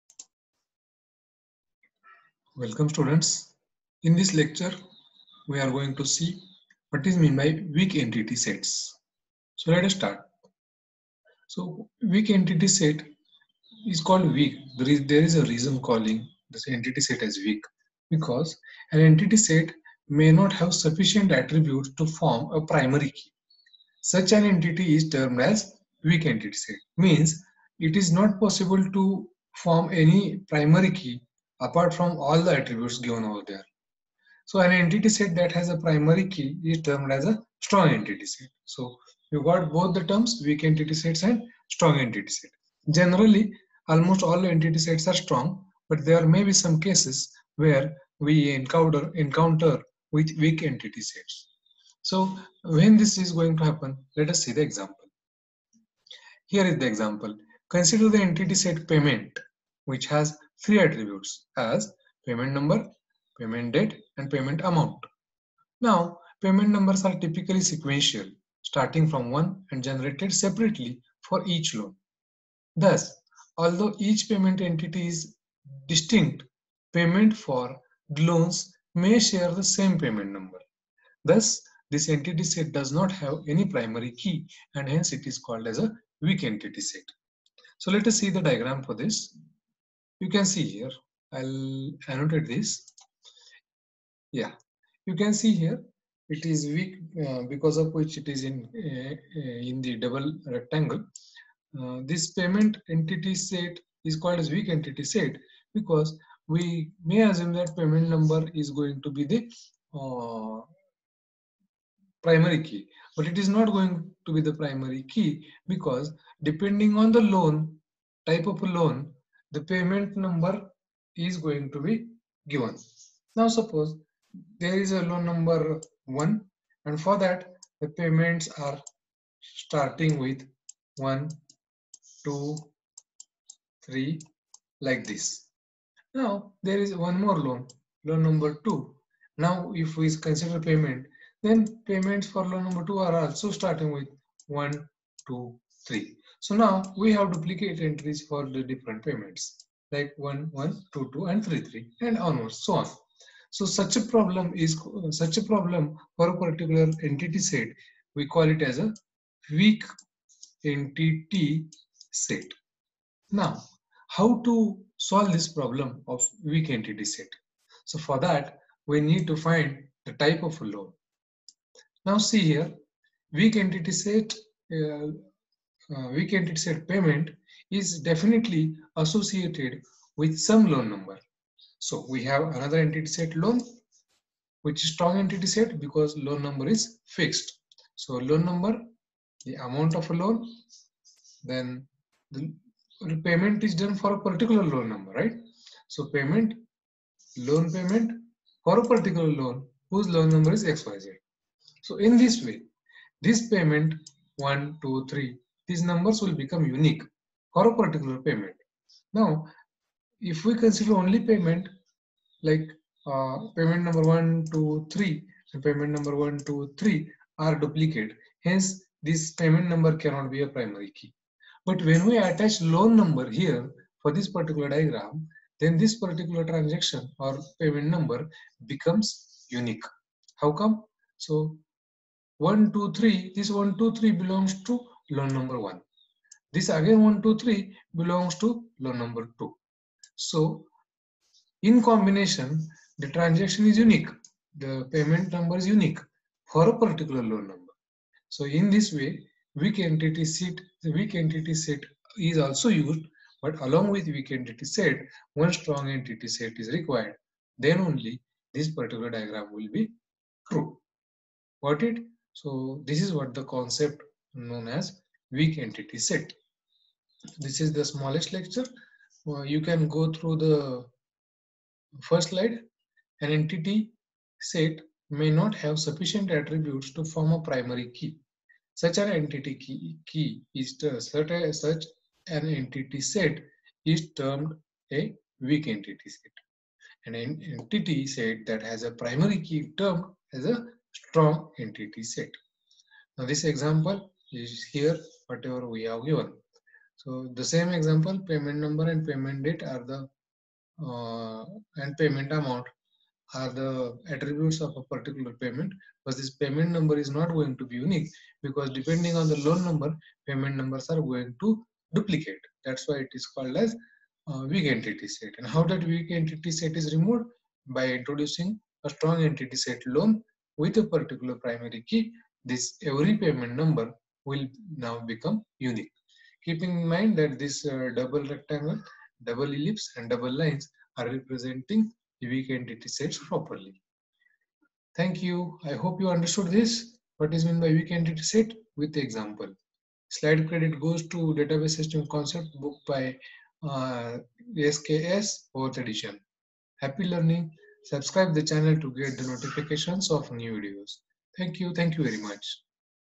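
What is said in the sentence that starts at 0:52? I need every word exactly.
So when this is going to happen, let us see the example.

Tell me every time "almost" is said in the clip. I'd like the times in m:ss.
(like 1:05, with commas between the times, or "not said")
0:43.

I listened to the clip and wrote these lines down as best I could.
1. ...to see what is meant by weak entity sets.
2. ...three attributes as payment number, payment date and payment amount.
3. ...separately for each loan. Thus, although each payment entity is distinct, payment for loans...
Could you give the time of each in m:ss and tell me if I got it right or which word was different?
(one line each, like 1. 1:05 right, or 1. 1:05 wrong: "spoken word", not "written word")
1. 0:05 right
2. 1:00 right
3. 1:10 right.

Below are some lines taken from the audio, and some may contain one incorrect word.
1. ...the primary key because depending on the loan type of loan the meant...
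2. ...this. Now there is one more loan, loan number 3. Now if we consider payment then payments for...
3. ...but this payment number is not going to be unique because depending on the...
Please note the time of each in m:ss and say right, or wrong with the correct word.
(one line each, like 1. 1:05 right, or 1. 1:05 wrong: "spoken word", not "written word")
1. 1:54 wrong: "payment", not "meant"
2. 2:15 wrong: "2", not "3"
3. 5:06 right.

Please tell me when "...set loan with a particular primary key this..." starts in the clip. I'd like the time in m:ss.
5:19.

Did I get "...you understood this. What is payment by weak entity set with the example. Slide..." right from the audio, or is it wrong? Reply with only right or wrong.
wrong.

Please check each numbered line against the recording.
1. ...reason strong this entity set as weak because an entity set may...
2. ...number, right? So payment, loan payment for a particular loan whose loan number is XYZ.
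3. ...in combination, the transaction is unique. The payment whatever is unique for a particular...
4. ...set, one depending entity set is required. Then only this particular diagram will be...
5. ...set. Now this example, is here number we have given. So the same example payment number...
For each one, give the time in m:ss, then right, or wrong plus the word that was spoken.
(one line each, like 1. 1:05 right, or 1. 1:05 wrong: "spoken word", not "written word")
1. 0:15 wrong: "calling", not "strong"
2. 3:14 right
3. 4:01 wrong: "number", not "whatever"
4. 4:14 wrong: "strong", not "depending"
5. 4:52 wrong: "whatever", not "number".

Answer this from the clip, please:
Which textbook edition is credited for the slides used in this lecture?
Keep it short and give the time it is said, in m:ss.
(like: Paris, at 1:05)
4th edition, at 5:45.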